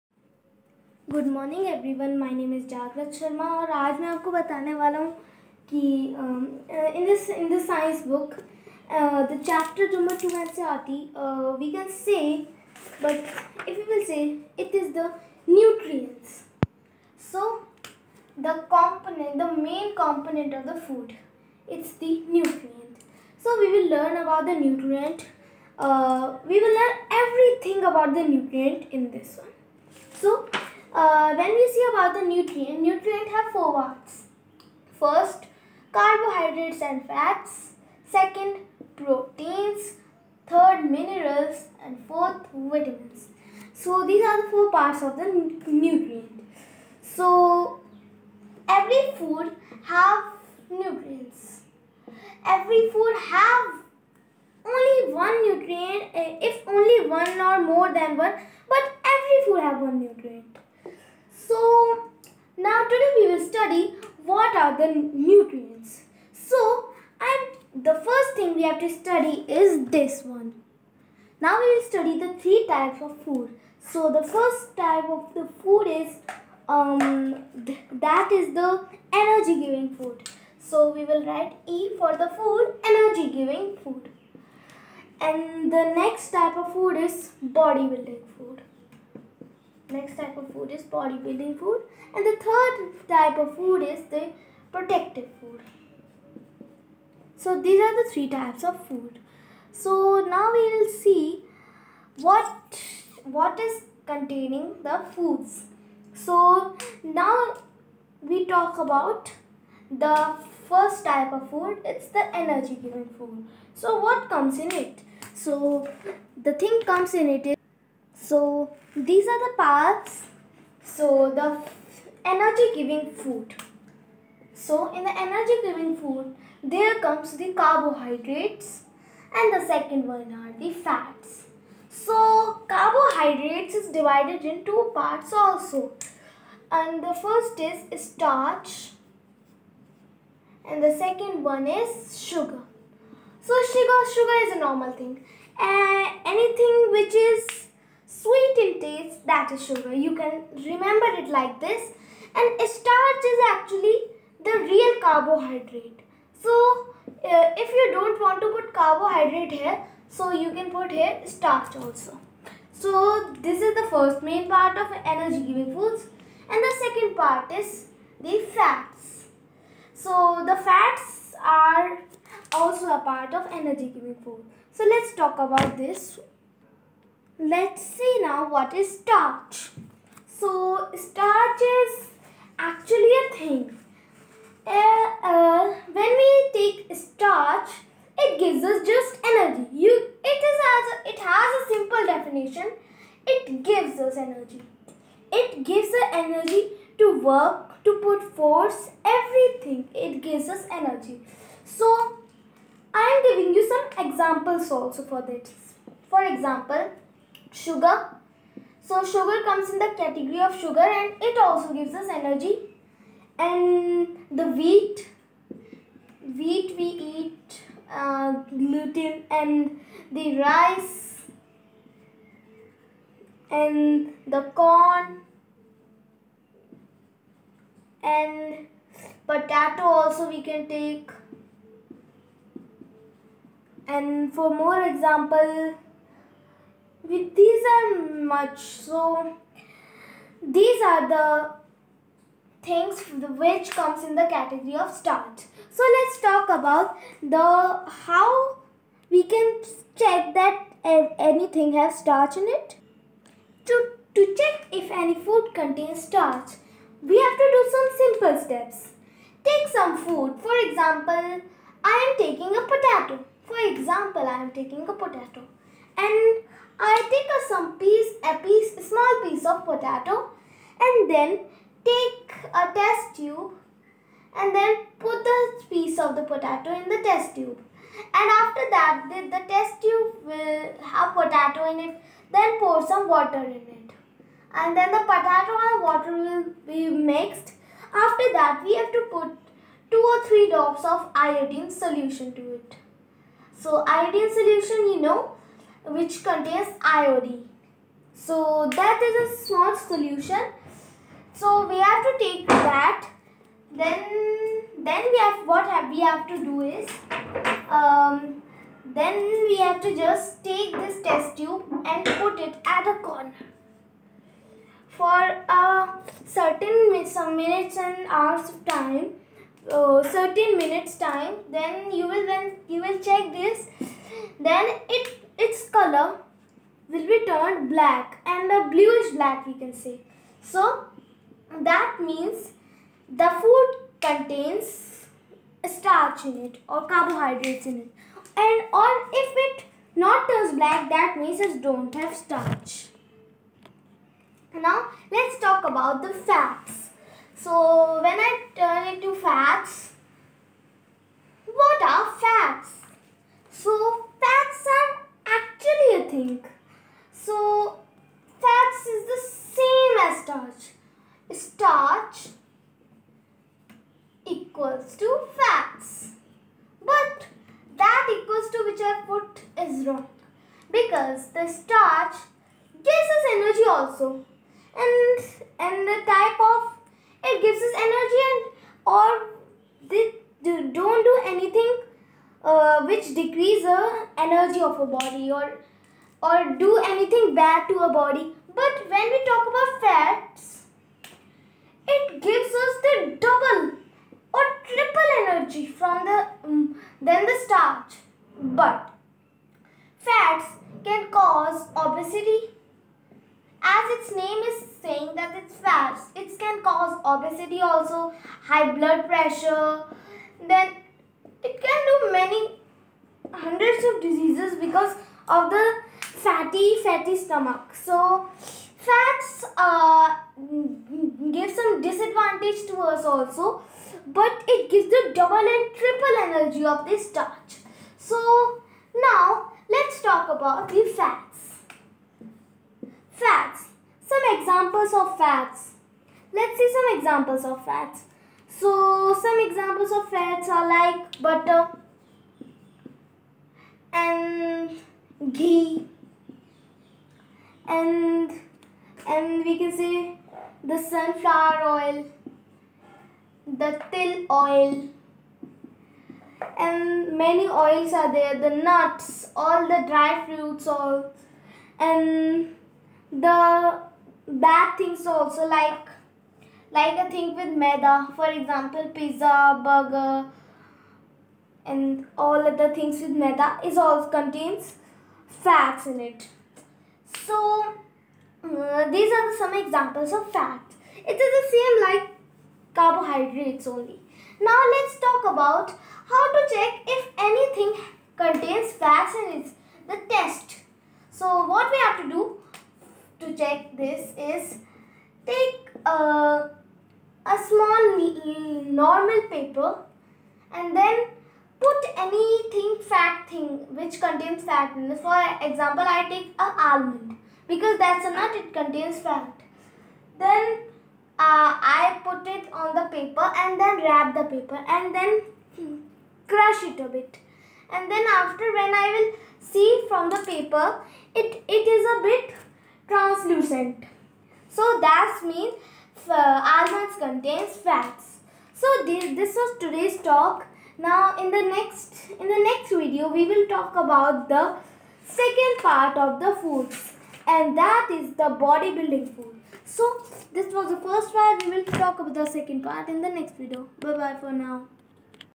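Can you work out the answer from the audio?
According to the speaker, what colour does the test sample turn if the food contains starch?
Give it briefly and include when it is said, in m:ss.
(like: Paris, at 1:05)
Bluish black, at 5:28.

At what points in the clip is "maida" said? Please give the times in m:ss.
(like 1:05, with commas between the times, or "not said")
7:47, 7:53.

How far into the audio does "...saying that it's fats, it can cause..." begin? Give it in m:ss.
6:44.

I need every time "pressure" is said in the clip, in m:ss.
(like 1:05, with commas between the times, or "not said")
6:49.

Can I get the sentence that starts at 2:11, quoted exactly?
So carbohydrates is divided in two parts also.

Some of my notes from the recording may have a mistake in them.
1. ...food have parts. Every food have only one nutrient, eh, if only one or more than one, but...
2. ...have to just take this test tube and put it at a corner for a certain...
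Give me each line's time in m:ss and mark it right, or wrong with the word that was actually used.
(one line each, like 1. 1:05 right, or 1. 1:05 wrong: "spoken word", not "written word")
1. 0:49 wrong: "nutrients", not "parts"
2. 5:09 right.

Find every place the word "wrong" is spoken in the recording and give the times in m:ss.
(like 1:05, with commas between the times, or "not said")
6:09.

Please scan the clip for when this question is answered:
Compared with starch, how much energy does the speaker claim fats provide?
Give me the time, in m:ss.
6:33.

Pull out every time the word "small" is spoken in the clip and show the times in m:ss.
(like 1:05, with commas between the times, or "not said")
4:28, 4:59, 8:17.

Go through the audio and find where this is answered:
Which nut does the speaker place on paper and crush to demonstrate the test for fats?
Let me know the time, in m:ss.
8:26.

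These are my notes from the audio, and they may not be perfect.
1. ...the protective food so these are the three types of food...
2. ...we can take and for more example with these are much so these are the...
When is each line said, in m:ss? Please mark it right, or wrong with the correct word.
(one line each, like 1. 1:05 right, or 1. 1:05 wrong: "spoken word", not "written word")
1. 1:34 right
2. 3:50 right.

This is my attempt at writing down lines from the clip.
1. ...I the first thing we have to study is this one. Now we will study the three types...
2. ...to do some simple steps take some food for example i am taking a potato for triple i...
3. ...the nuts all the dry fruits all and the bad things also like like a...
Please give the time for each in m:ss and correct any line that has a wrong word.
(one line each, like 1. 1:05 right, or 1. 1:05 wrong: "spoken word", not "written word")
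1. 1:07 right
2. 4:17 wrong: "example", not "triple"
3. 7:38 right.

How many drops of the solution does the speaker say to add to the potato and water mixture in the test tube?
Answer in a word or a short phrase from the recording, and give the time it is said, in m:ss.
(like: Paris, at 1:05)
2 or 3, at 4:49.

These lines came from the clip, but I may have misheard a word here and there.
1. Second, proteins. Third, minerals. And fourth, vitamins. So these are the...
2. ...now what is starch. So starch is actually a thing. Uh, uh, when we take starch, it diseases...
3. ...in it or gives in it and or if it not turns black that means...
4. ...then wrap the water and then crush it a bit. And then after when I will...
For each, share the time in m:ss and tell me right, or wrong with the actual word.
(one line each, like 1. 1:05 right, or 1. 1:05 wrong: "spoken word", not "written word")
1. 0:38 right
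2. 2:58 wrong: "gives", not "diseases"
3. 5:36 wrong: "carbohydrates", not "gives"
4. 8:33 wrong: "paper", not "water".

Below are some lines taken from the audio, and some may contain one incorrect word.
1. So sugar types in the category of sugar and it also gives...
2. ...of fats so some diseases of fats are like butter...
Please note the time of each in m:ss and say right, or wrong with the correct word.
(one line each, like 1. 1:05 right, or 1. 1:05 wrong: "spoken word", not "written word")
1. 3:28 wrong: "comes", not "types"
2. 7:17 wrong: "examples", not "diseases".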